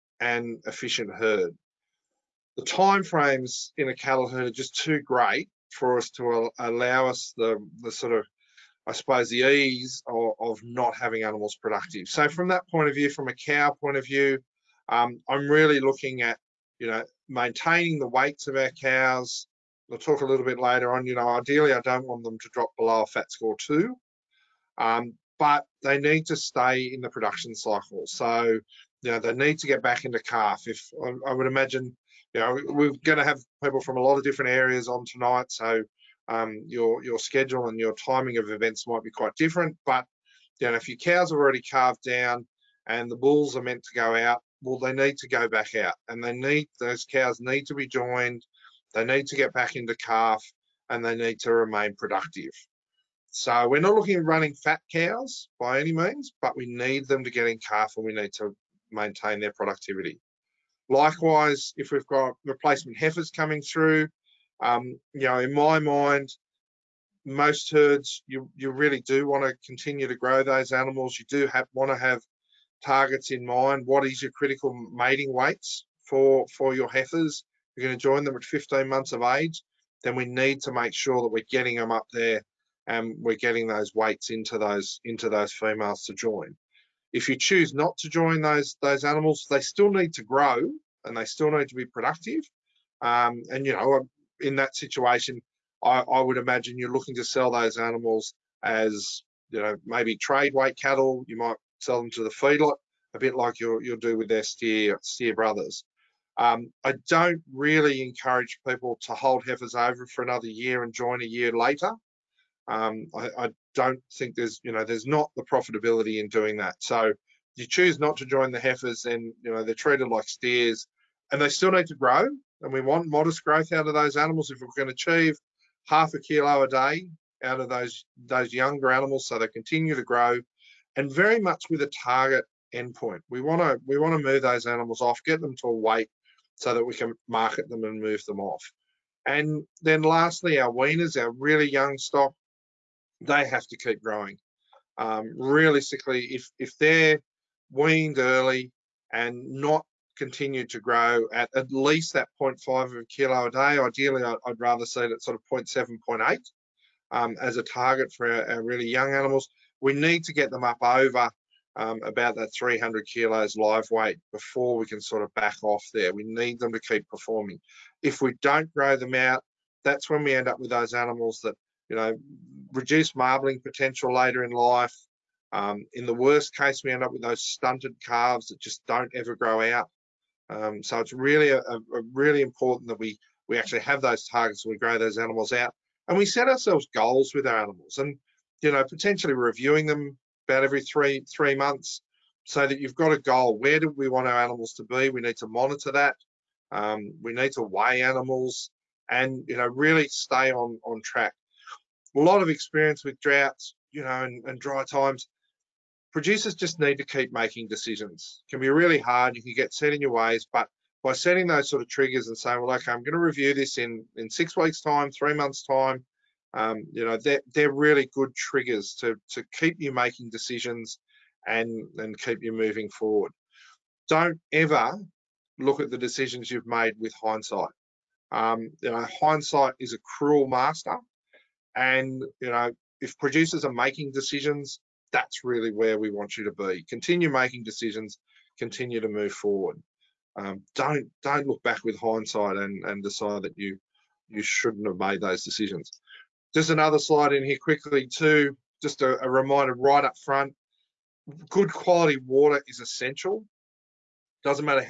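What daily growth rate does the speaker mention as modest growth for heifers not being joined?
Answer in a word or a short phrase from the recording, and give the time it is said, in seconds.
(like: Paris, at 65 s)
Half a kilo a day, at 125 s.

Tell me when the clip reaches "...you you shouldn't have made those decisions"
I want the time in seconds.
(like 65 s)
243 s.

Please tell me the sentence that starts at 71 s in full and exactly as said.
You do have want to have targets in mind.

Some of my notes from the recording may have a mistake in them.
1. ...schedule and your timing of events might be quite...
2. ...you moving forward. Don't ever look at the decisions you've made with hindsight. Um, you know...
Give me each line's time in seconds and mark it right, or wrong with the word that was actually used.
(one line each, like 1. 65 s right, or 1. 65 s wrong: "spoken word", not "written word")
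1. 37 s right
2. 222 s right.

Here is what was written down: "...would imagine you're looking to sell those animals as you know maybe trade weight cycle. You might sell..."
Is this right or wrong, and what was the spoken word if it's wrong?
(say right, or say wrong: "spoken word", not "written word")
wrong: "cattle", not "cycle".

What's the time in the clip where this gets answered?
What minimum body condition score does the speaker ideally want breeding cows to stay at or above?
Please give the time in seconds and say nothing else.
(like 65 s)
23 s.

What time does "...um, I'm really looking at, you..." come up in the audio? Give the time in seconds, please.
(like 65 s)
14 s.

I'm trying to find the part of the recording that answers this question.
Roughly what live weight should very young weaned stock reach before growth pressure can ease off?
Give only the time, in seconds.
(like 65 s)
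162 s.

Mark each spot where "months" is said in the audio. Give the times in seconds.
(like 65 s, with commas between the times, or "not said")
78 s, 191 s, 215 s.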